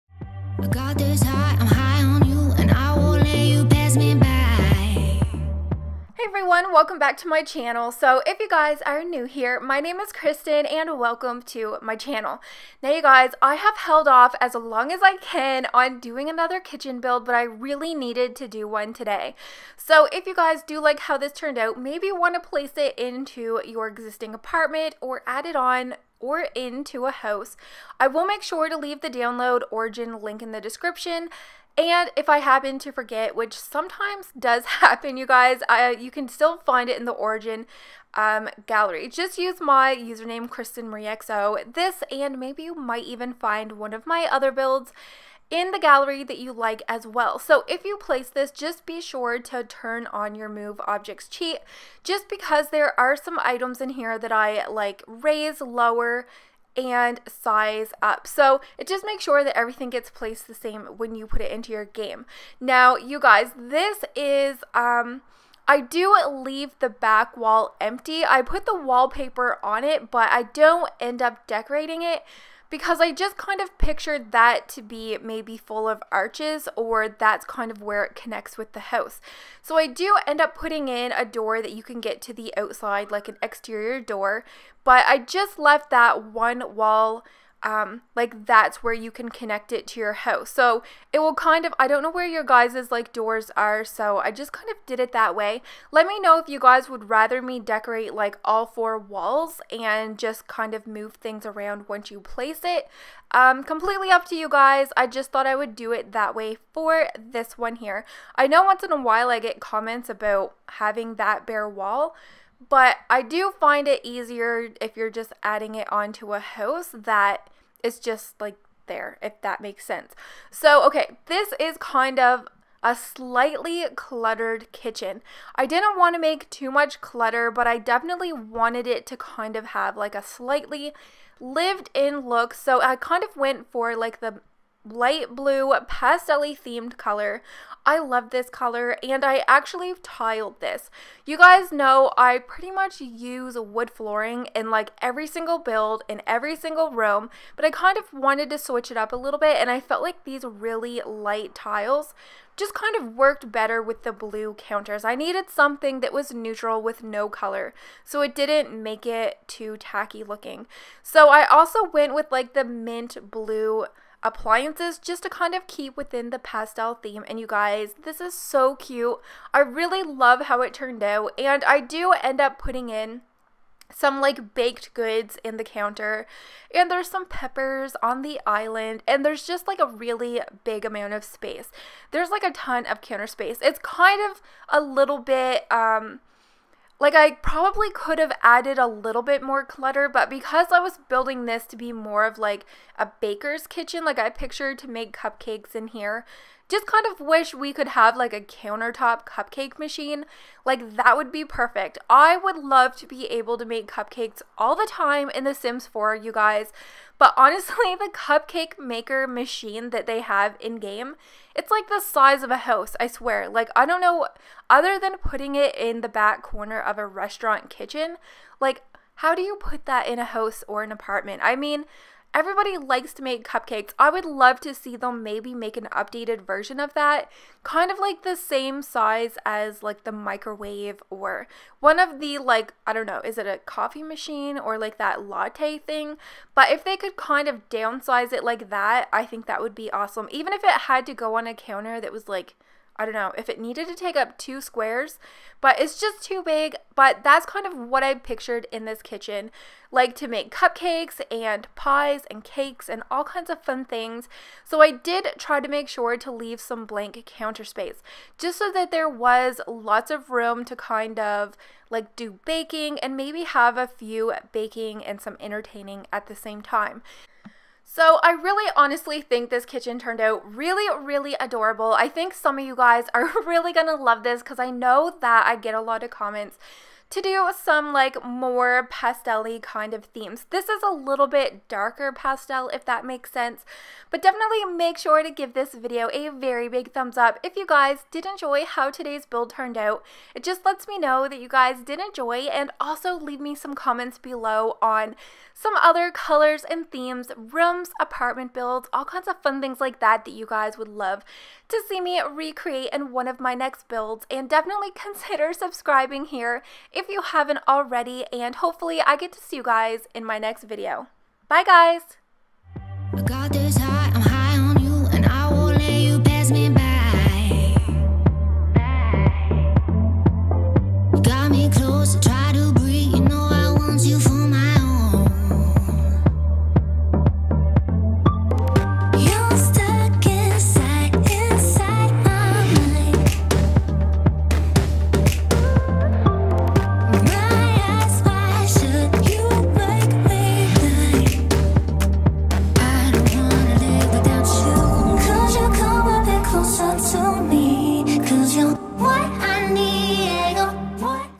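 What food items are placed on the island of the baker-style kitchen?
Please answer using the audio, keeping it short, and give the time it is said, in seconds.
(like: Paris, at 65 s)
peppers, at 177 s.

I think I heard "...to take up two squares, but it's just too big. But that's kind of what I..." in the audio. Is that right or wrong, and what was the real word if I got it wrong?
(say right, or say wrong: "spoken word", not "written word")
right.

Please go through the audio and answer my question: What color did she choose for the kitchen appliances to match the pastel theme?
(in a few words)
mint blue.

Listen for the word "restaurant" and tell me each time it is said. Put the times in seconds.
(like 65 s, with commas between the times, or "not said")
217 s.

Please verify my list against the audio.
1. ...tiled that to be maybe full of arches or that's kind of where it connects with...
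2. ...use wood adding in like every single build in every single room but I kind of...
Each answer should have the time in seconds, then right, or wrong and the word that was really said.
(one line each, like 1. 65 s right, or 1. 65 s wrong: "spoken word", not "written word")
1. 73 s wrong: "pictured", not "tiled"
2. 143 s wrong: "flooring", not "adding".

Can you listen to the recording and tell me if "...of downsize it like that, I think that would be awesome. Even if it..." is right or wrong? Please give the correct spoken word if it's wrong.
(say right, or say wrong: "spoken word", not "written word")
right.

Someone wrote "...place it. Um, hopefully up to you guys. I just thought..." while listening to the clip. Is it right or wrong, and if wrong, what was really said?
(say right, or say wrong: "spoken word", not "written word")
wrong: "completely", not "hopefully".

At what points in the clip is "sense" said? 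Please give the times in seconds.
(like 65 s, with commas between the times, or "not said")
119 s, 283 s.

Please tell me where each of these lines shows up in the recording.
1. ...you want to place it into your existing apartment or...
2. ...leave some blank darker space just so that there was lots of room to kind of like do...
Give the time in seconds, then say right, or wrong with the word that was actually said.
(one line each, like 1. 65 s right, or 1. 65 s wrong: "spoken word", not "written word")
1. 22 s right
2. 256 s wrong: "counter", not "darker".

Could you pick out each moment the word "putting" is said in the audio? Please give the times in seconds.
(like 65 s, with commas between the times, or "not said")
80 s, 172 s, 215 s.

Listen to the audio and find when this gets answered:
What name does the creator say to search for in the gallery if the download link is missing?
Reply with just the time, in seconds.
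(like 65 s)
40 s.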